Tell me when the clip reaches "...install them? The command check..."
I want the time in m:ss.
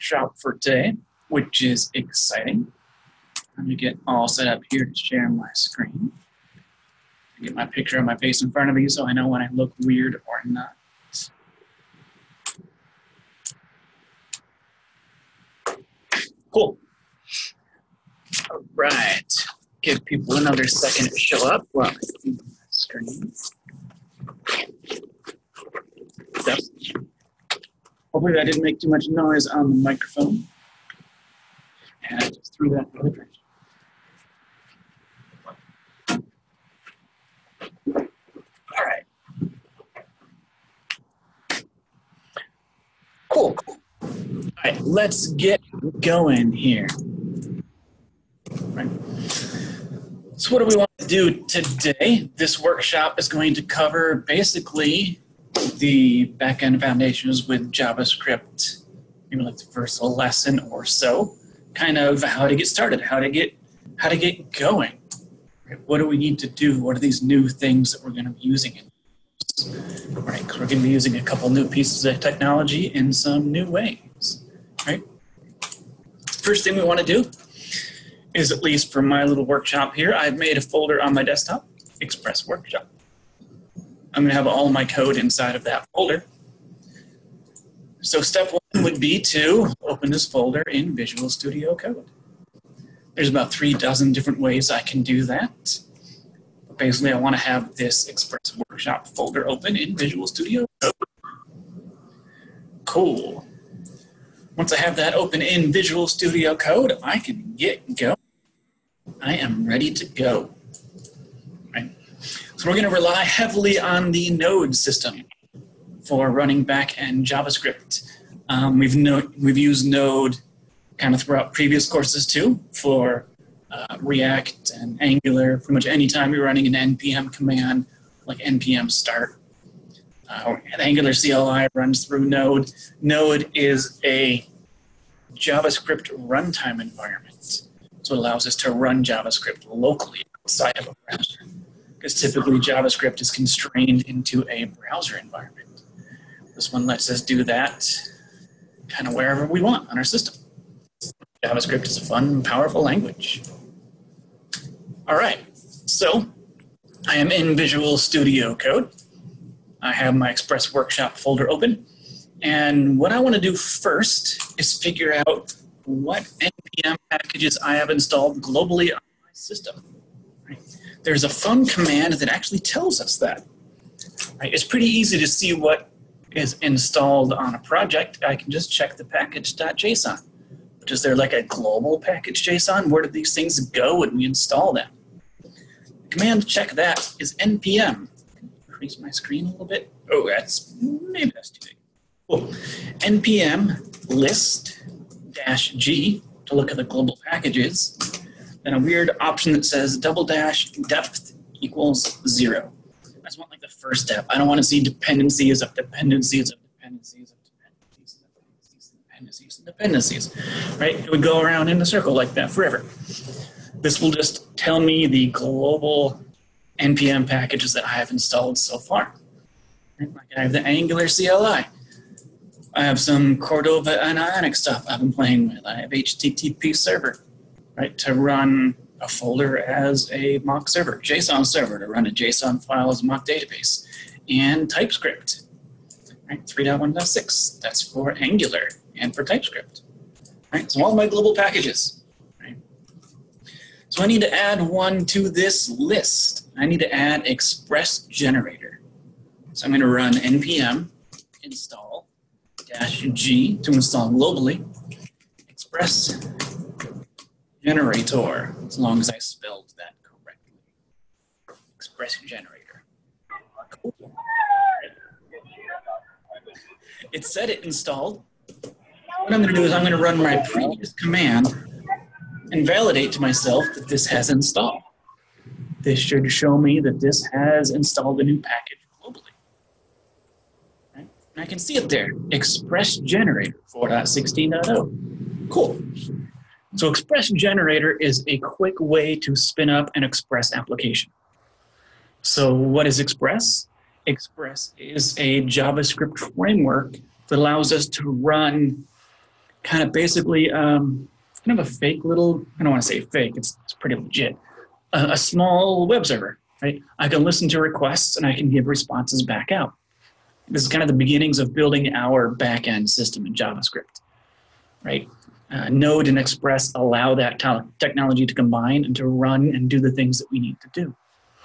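3:04.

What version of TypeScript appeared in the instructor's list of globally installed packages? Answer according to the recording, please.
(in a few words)
3.1.6.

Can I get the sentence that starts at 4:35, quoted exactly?
This should show me that this has installed a new package globally.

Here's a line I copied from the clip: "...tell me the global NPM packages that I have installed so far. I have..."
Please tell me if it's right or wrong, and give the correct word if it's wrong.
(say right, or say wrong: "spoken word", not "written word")
right.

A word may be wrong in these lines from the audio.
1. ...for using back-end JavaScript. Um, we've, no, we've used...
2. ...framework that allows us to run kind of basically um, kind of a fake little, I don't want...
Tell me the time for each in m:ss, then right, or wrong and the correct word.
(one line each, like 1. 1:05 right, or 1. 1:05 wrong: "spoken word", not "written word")
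1. 1:56 wrong: "running", not "using"
2. 4:56 right.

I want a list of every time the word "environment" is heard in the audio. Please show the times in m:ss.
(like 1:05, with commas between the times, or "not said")
2:16, 2:25.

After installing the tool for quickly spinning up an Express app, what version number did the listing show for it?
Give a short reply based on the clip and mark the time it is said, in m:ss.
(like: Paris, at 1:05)
4.16.0, at 4:43.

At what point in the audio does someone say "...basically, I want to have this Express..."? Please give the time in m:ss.
1:36.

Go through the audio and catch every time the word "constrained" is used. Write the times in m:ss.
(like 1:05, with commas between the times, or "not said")
2:23.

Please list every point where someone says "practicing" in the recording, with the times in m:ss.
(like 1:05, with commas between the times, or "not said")
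not said.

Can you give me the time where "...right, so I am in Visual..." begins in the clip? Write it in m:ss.
2:35.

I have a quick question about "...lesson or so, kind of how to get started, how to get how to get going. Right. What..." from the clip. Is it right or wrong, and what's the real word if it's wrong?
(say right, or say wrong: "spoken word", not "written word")
right.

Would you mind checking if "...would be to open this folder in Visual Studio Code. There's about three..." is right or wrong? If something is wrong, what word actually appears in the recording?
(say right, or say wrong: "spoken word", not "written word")
right.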